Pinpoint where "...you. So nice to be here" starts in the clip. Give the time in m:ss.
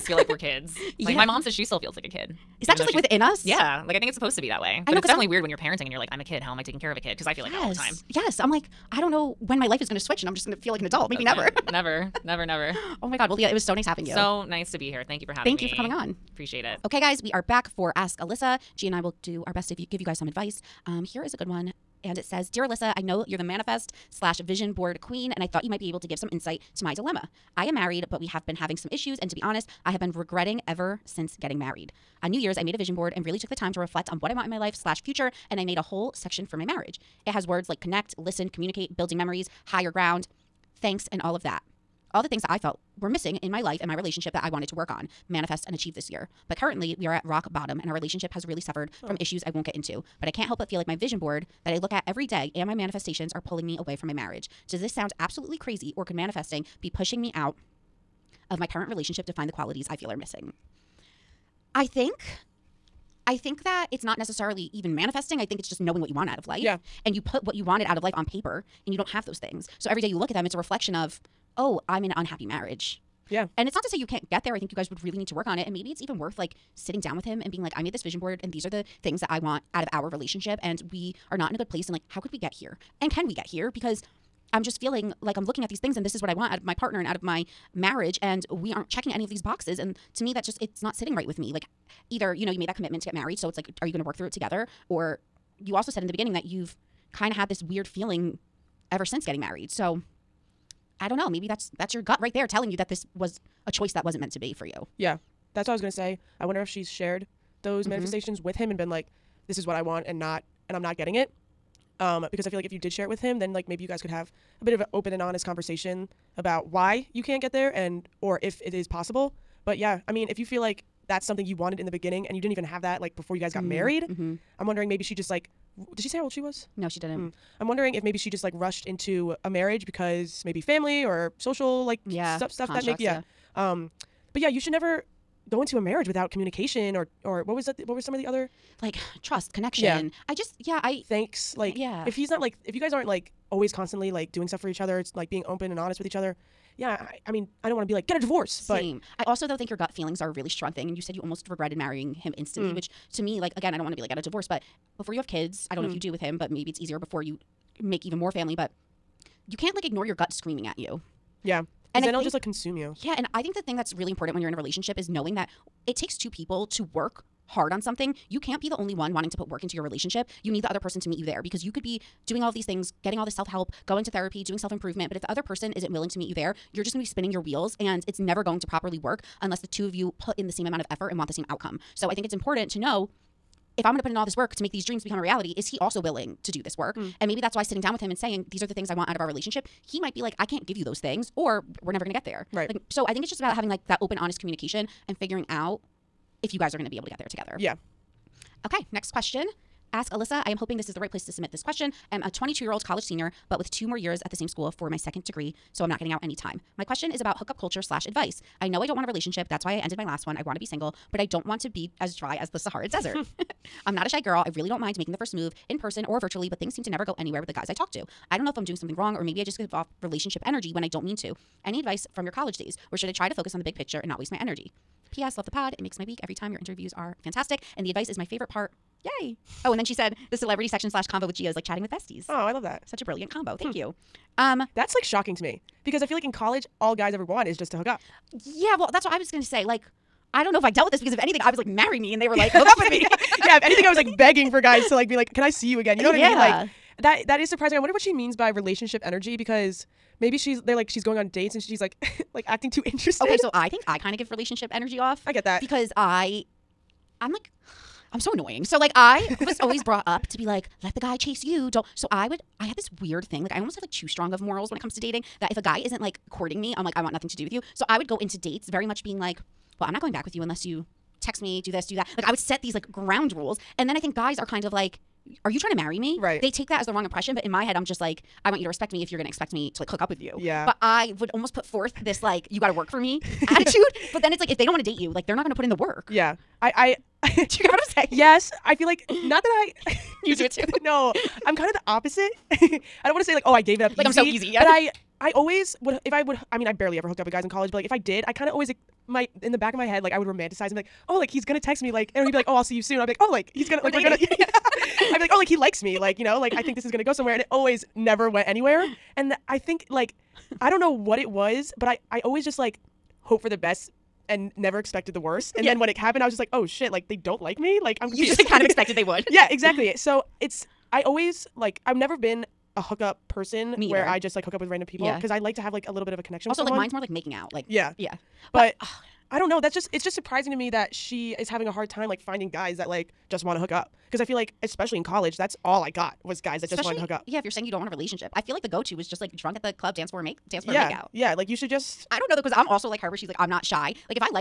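0:14.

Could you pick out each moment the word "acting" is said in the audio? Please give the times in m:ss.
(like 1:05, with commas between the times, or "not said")
4:12.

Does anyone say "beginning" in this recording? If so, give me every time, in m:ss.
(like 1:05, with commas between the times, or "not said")
1:36, 2:01.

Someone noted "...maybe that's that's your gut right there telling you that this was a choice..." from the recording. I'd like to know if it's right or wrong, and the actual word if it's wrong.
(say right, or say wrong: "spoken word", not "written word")
right.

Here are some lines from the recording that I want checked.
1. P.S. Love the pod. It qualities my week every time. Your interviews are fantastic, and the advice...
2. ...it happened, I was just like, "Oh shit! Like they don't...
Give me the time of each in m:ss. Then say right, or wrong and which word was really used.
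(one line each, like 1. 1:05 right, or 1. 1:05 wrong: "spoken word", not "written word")
1. 3:45 wrong: "makes", not "qualities"
2. 5:15 right.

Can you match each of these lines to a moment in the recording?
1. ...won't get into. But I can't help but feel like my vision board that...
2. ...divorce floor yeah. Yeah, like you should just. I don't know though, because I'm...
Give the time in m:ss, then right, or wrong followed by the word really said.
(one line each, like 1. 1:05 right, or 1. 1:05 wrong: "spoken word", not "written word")
1. 0:49 right
2. 5:40 wrong: "dance", not "divorce".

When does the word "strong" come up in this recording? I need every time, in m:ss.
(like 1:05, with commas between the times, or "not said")
2:30, 4:24.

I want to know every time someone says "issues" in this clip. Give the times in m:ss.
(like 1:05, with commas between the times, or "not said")
0:28, 0:49.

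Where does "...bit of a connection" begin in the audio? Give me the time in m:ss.
5:26.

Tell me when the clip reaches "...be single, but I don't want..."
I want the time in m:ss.
3:30.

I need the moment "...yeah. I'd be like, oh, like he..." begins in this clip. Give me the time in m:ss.
5:04.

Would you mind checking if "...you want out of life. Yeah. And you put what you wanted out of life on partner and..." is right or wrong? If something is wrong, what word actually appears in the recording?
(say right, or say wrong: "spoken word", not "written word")
wrong: "paper", not "partner".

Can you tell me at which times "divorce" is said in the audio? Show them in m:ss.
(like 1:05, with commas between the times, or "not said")
2:28, 2:34.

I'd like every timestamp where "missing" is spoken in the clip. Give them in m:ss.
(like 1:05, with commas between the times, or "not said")
0:43, 1:00.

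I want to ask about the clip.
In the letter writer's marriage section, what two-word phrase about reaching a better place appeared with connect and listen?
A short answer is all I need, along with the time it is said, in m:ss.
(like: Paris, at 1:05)
higher ground, at 0:39.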